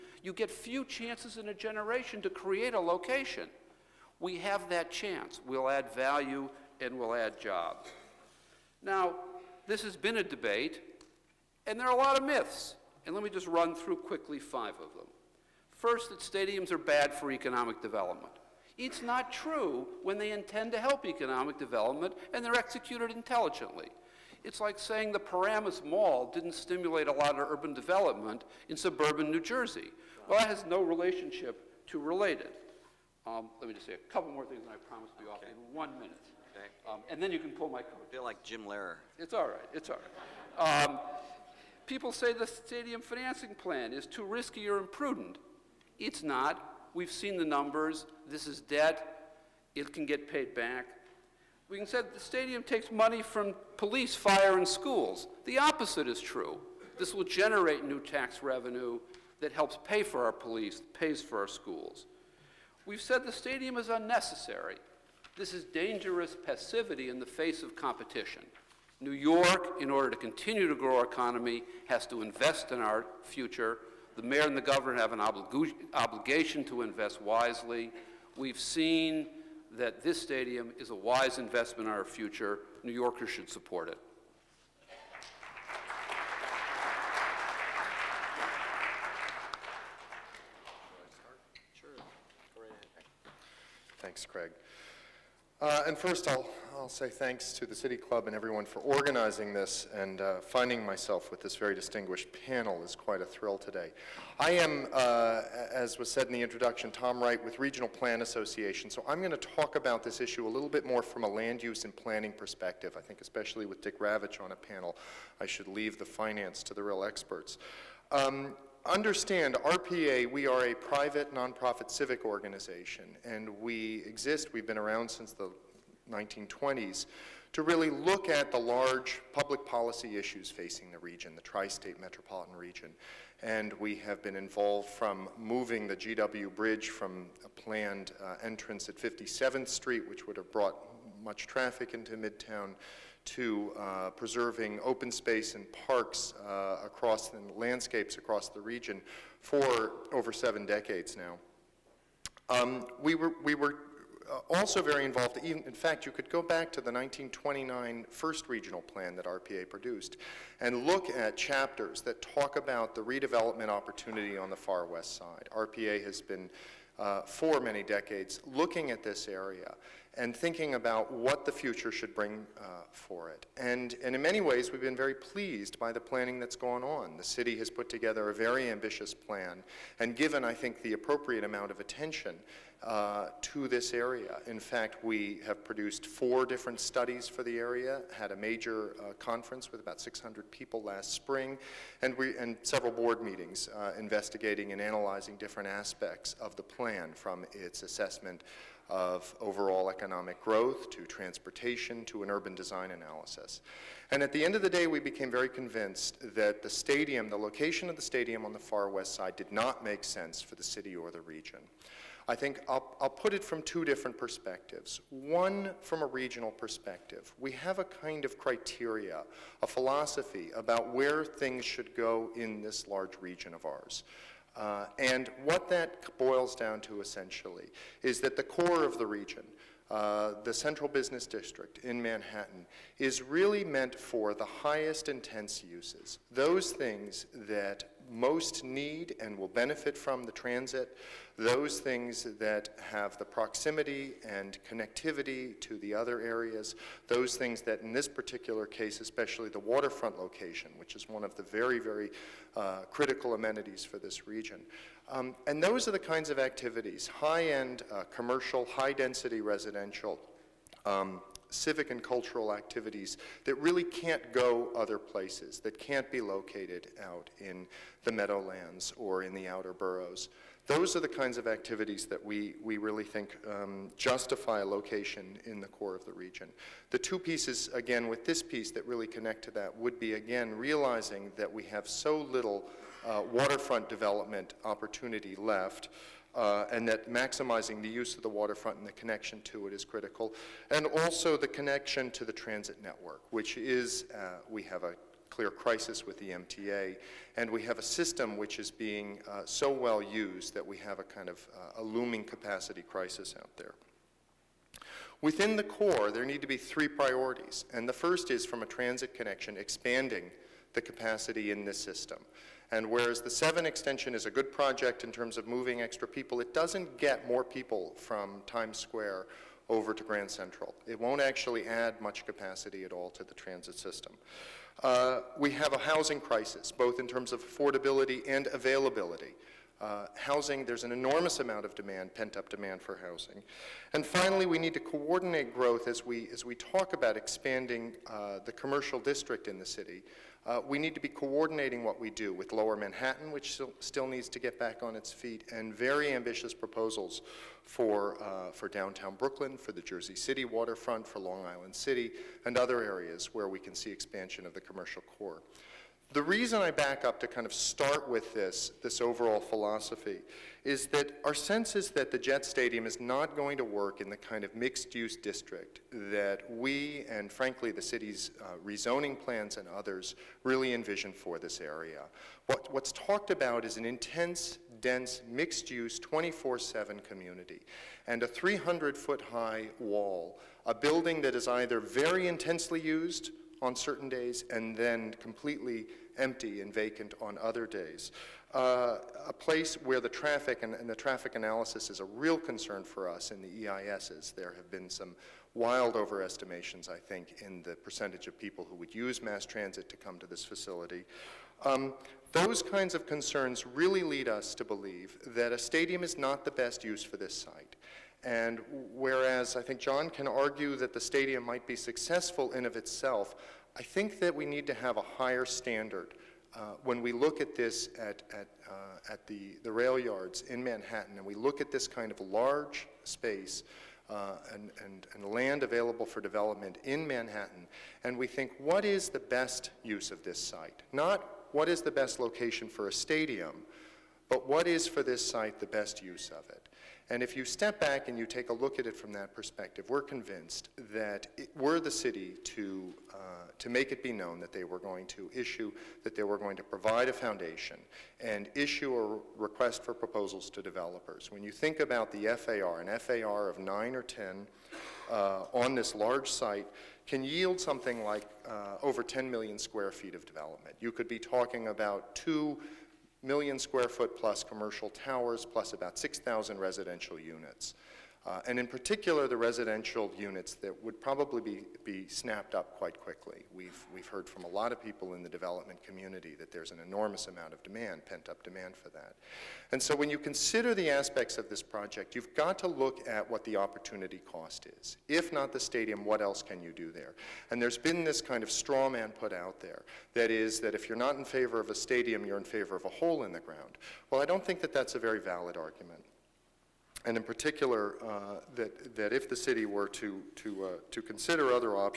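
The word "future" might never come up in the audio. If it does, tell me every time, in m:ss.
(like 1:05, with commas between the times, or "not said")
1:13, 1:22, 2:51.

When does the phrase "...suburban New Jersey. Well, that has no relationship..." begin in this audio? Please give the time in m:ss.
0:28.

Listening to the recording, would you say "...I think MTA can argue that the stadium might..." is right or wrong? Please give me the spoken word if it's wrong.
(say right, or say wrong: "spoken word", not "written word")
wrong: "John", not "MTA".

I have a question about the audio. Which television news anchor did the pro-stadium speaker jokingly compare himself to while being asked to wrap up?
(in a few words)
Jim Lehrer.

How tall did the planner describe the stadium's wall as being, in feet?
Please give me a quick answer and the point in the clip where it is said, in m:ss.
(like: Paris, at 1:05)
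300 feet, at 6:18.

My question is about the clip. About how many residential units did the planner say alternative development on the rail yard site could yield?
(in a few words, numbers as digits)
6,000.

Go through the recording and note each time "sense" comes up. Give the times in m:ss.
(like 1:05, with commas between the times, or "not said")
3:30, 6:01.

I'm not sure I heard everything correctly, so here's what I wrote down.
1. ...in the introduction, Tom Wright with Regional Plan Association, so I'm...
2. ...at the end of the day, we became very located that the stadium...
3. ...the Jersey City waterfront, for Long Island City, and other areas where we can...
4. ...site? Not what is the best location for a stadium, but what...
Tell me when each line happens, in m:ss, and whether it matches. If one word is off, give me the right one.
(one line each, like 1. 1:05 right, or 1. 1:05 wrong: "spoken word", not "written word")
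1. 1:46 right
2. 3:24 wrong: "convinced", not "located"
3. 5:49 right
4. 7:10 right.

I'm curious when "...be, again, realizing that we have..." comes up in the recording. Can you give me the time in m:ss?
4:39.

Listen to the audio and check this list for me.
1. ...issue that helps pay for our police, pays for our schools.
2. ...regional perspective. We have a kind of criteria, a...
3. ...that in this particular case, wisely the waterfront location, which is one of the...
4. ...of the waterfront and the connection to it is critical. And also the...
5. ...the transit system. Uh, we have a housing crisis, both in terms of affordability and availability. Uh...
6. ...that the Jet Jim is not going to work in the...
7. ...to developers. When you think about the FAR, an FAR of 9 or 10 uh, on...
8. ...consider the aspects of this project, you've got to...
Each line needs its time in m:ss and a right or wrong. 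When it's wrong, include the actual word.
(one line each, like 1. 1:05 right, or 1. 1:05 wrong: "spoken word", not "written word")
1. 0:58 wrong: "revenue", not "issue"
2. 3:36 right
3. 4:07 wrong: "especially", not "wisely"
4. 4:48 right
5. 5:23 right
6. 6:01 wrong: "Stadium", not "Jim"
7. 7:30 right
8. 8:00 right.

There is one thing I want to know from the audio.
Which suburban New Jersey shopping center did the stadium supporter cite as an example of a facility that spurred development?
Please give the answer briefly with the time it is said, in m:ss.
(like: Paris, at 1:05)
Paramus Mall, at 0:25.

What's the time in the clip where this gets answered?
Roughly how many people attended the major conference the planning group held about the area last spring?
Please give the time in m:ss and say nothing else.
3:10.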